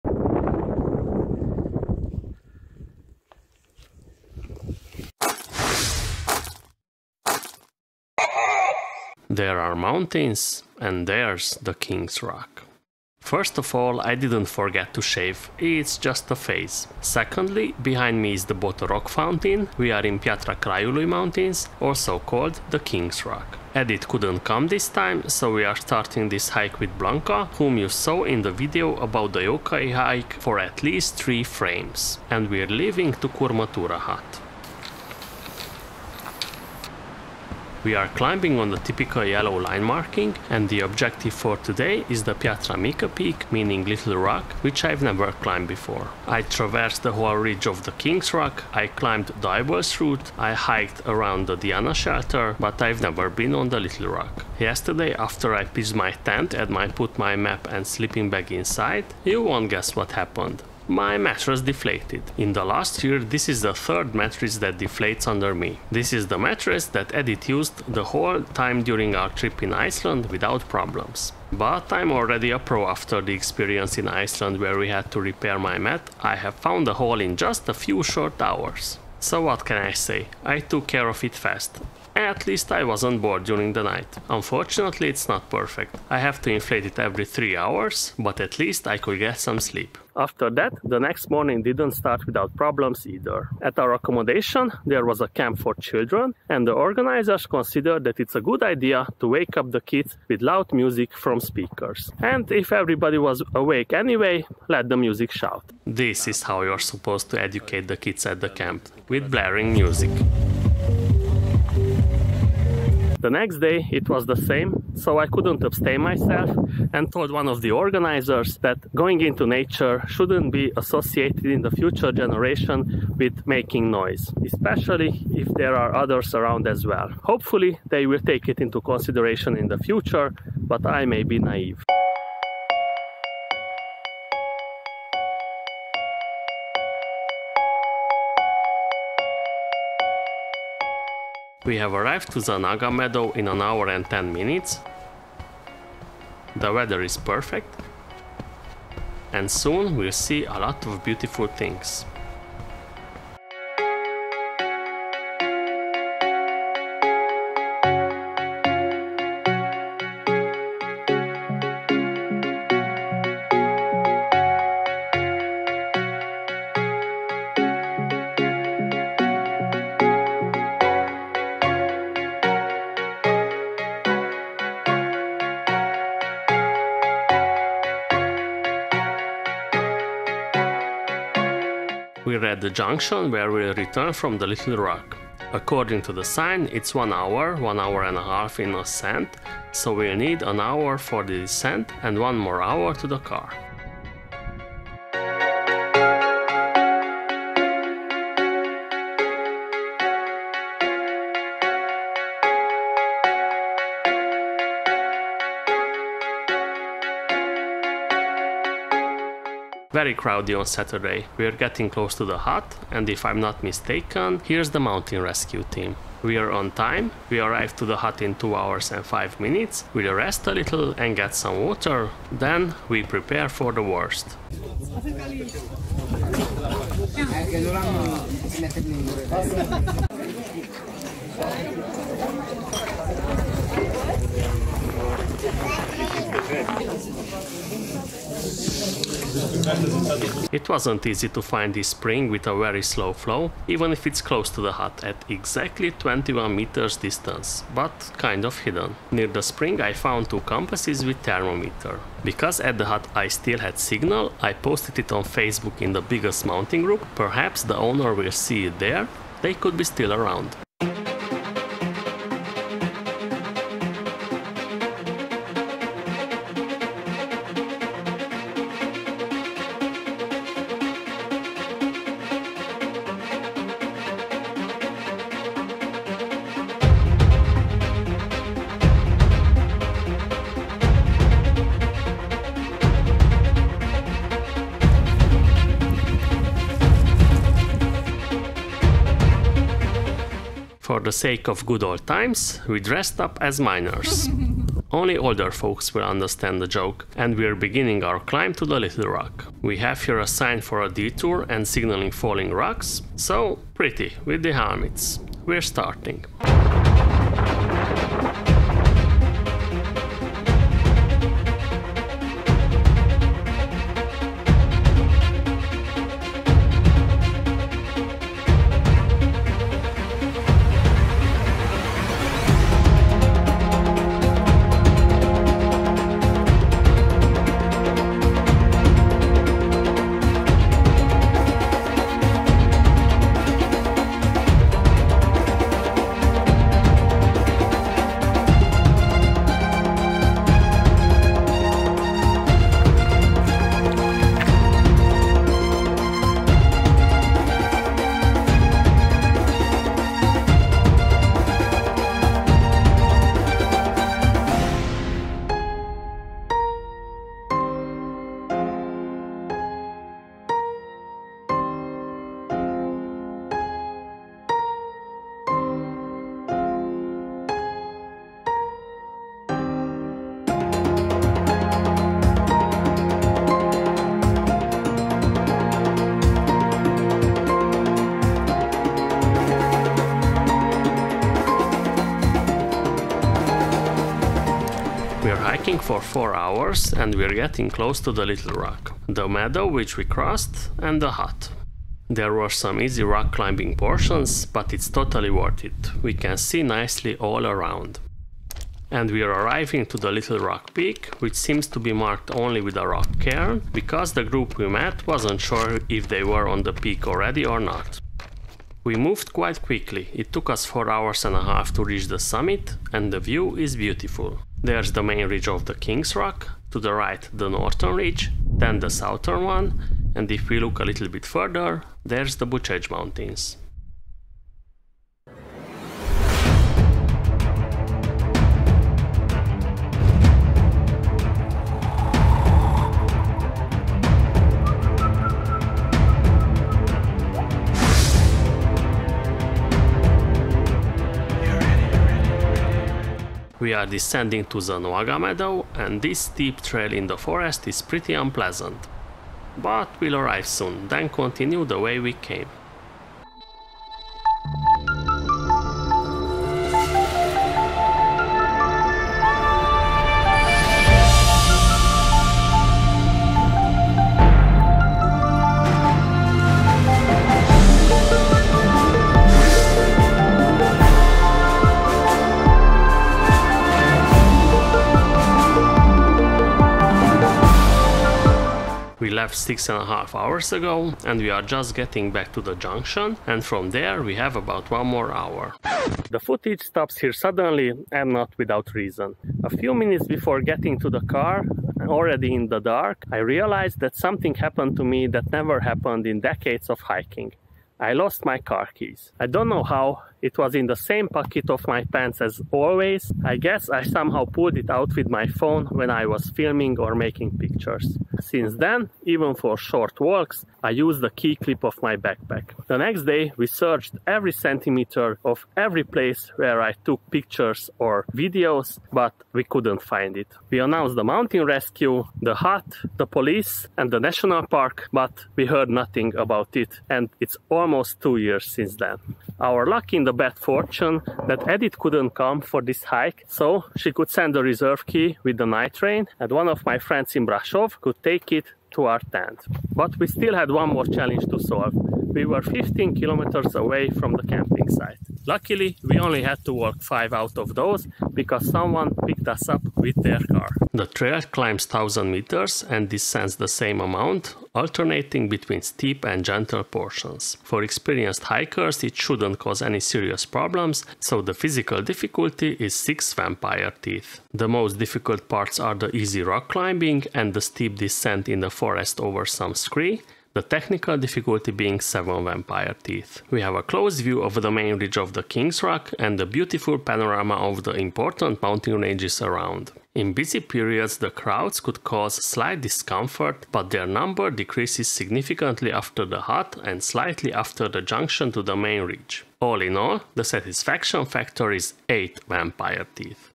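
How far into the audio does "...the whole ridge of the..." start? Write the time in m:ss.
0:47.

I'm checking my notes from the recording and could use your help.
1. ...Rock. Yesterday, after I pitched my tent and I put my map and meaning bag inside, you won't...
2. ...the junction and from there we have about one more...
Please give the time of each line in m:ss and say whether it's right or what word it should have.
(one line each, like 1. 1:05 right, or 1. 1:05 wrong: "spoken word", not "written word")
1. 0:54 wrong: "sleeping", not "meaning"
2. 8:02 right.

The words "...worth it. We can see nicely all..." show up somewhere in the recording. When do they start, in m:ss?
6:35.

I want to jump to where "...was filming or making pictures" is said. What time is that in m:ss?
8:26.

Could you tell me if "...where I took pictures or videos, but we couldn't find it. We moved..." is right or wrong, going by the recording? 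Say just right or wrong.
wrong.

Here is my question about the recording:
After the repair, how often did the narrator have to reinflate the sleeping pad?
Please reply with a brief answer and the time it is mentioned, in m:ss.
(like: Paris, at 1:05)
Every 3 hours, at 1:26.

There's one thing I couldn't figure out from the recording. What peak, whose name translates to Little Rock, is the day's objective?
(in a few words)
Piatra Mica.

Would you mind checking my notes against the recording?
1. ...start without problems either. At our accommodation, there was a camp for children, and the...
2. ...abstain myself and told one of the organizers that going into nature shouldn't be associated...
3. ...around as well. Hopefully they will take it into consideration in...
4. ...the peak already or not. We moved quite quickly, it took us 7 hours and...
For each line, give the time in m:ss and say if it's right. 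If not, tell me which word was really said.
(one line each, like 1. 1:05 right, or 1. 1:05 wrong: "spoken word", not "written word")
1. 1:31 right
2. 1:55 right
3. 2:06 right
4. 6:46 wrong: "4", not "7".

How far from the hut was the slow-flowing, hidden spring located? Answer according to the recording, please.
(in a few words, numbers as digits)
21 meters.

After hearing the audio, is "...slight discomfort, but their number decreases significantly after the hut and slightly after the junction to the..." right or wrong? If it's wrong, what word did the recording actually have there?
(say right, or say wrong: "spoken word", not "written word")
right.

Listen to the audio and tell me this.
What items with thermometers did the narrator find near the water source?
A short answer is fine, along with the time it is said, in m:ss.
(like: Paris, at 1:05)
Two compasses, at 4:10.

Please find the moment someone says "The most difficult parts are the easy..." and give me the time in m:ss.
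9:24.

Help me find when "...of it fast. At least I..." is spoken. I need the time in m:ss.
1:21.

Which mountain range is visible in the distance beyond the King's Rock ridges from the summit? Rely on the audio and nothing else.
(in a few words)
Bucegi Mountains.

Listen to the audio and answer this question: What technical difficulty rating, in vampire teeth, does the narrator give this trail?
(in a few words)
7.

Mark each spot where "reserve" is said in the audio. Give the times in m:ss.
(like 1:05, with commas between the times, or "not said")
8:54.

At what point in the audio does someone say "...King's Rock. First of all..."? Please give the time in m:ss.
0:11.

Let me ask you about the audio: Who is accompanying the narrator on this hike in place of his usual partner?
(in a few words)
Blanca.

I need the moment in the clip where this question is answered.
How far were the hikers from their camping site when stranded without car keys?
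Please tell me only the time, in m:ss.
9:02.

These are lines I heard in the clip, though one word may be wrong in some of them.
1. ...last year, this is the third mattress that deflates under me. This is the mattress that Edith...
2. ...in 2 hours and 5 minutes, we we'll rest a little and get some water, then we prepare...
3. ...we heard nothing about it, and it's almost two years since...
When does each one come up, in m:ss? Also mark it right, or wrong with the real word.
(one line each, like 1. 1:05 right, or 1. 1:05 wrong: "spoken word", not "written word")
1. 1:02 right
2. 3:38 right
3. 8:45 right.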